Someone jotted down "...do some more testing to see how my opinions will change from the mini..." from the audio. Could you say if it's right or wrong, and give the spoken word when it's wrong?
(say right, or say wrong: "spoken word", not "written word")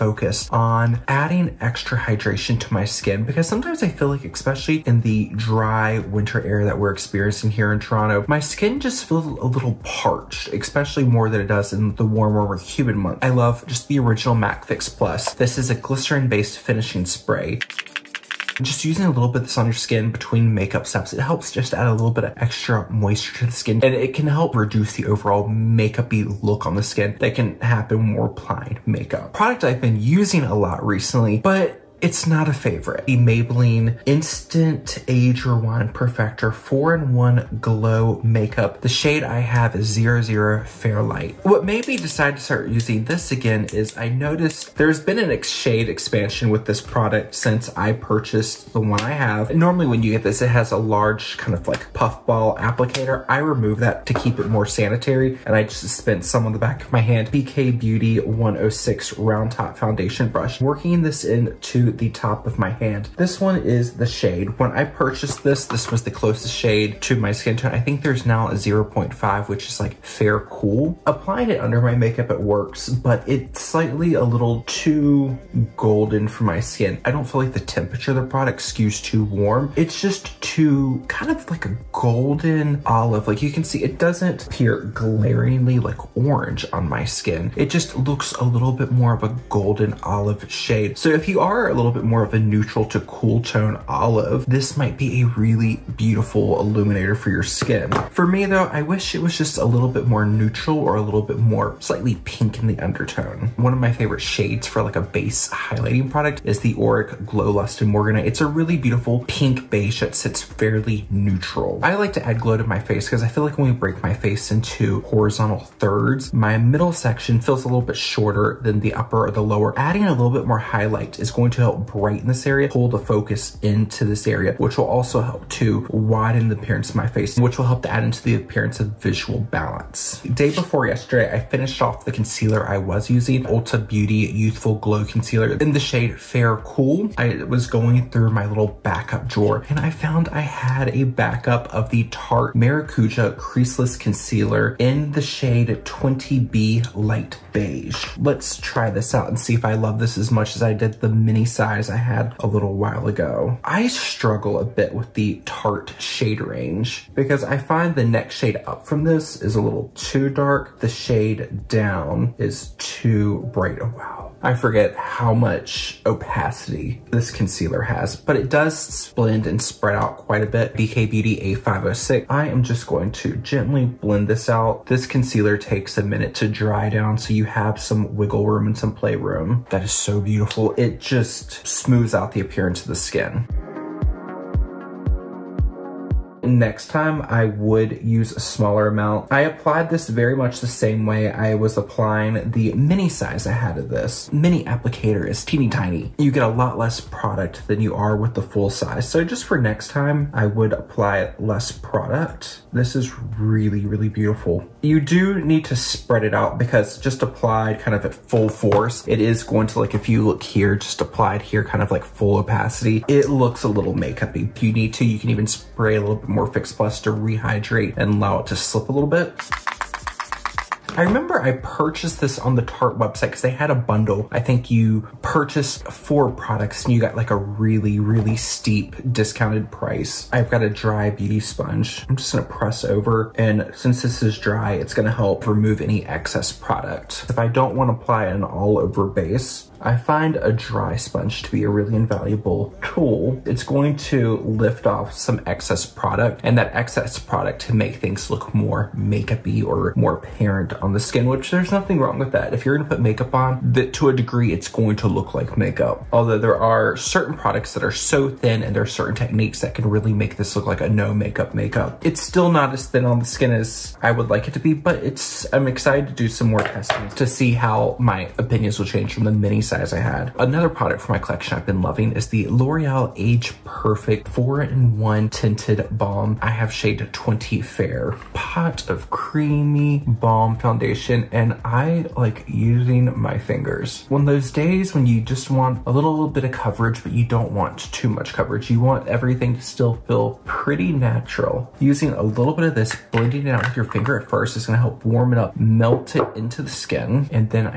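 right.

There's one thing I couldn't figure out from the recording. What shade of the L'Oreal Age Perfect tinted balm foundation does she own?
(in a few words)
20 Fair.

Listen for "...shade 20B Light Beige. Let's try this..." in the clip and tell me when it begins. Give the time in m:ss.
2:25.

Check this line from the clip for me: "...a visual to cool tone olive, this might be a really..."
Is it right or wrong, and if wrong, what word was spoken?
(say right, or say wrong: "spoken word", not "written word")
wrong: "neutral", not "visual".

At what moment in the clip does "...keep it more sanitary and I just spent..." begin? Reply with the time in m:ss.
0:54.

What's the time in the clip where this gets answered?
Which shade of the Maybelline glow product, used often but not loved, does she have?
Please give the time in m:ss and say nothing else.
0:39.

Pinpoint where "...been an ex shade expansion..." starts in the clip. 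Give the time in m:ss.
0:44.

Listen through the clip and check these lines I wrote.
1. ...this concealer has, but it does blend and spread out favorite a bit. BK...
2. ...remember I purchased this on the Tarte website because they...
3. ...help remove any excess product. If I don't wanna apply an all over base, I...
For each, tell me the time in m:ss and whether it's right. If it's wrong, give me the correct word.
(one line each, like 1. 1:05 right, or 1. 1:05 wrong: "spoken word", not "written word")
1. 2:47 wrong: "quite", not "favorite"
2. 3:41 right
3. 3:55 right.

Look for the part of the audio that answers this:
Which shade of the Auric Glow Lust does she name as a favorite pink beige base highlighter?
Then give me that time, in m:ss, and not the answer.
1:47.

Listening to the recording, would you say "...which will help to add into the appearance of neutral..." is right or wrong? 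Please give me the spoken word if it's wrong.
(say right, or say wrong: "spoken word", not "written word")
wrong: "visual", not "neutral".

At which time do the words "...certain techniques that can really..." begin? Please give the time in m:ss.
4:18.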